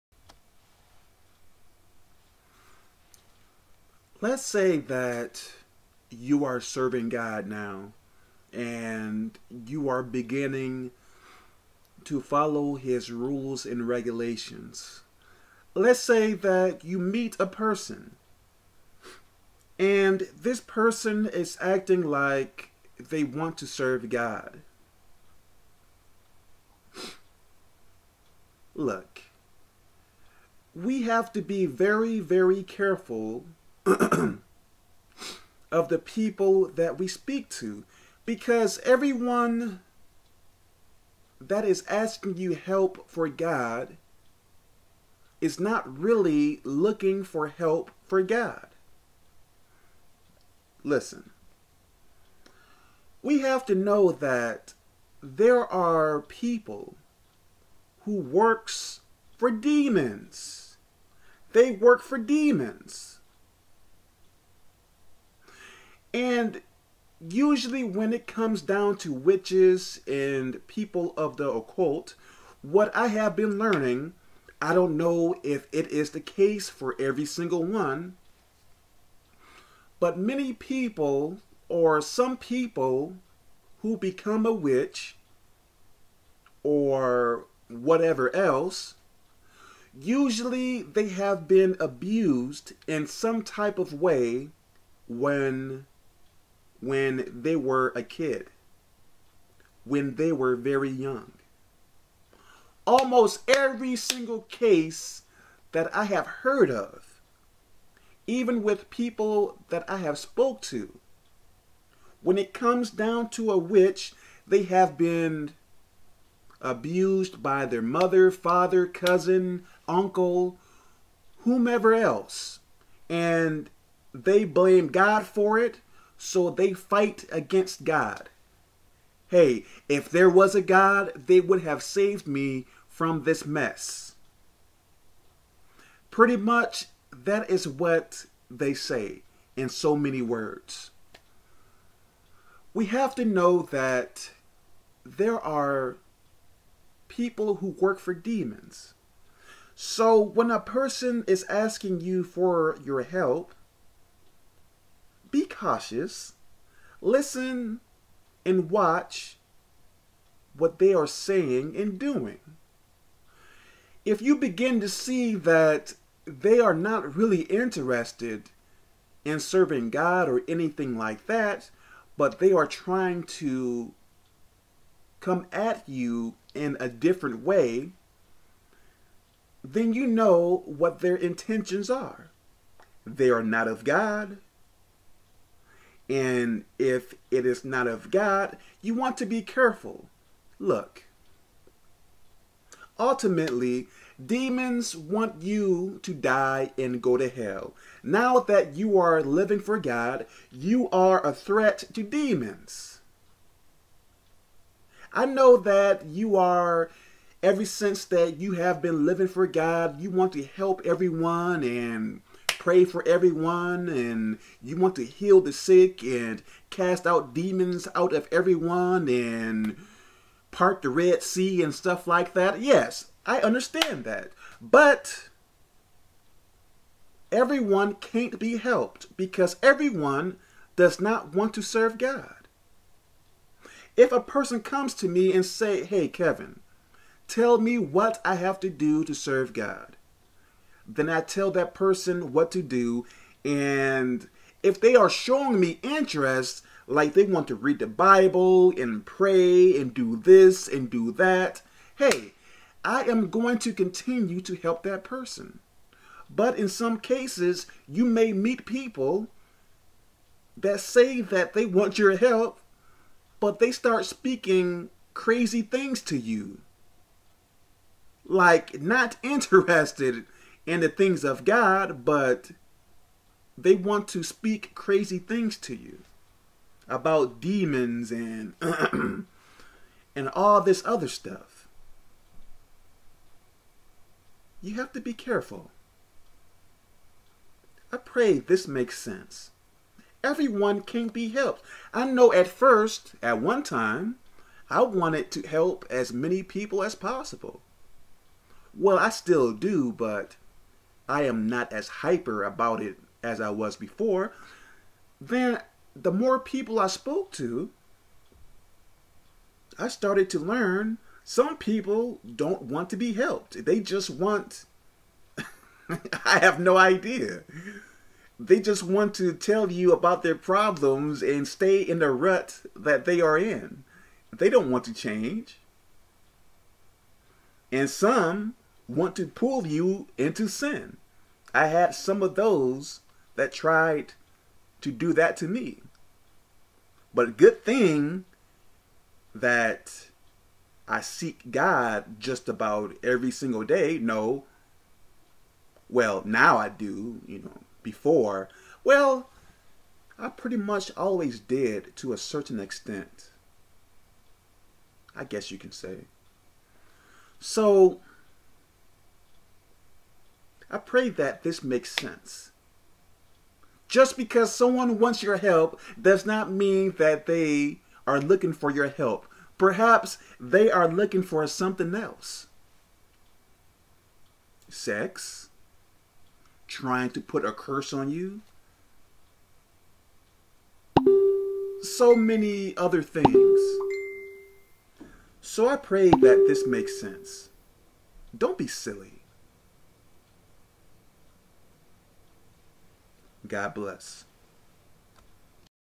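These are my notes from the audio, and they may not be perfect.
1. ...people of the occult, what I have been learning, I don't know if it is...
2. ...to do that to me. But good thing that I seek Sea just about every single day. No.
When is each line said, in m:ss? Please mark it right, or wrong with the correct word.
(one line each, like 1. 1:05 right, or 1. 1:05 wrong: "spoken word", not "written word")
1. 1:10 right
2. 5:34 wrong: "God", not "Sea".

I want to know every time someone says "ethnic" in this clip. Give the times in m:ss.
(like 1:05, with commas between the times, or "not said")
not said.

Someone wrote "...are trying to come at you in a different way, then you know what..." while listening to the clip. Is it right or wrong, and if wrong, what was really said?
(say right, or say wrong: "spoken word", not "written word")
right.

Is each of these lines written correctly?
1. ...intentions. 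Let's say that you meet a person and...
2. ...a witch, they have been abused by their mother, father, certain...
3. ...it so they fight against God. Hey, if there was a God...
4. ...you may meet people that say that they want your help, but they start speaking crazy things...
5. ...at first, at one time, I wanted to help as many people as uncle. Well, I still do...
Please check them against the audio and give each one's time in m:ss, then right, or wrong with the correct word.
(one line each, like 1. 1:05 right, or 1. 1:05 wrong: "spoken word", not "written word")
1. 0:13 wrong: "regulations", not "intentions"
2. 1:53 wrong: "cousin", not "certain"
3. 2:05 right
4. 4:17 right
5. 4:52 wrong: "possible", not "uncle".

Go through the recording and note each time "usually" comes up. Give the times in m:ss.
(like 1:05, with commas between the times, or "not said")
1:07, 1:29.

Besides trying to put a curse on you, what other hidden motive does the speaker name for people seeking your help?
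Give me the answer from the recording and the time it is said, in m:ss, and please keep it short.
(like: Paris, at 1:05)
Sex, at 6:14.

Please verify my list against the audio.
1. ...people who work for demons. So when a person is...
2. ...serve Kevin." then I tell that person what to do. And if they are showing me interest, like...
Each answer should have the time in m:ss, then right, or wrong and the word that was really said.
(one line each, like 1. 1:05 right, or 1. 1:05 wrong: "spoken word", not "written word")
1. 2:27 right
2. 3:59 wrong: "God", not "Kevin".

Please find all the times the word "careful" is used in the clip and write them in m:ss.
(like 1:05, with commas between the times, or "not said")
0:32, 3:09, 4:45.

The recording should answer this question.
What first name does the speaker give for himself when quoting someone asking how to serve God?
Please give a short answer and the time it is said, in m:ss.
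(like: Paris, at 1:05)
Kevin, at 3:56.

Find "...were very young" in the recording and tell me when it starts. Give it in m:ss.
1:40.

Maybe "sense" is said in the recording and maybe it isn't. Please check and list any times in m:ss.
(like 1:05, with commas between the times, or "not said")
4:48, 6:01, 6:27.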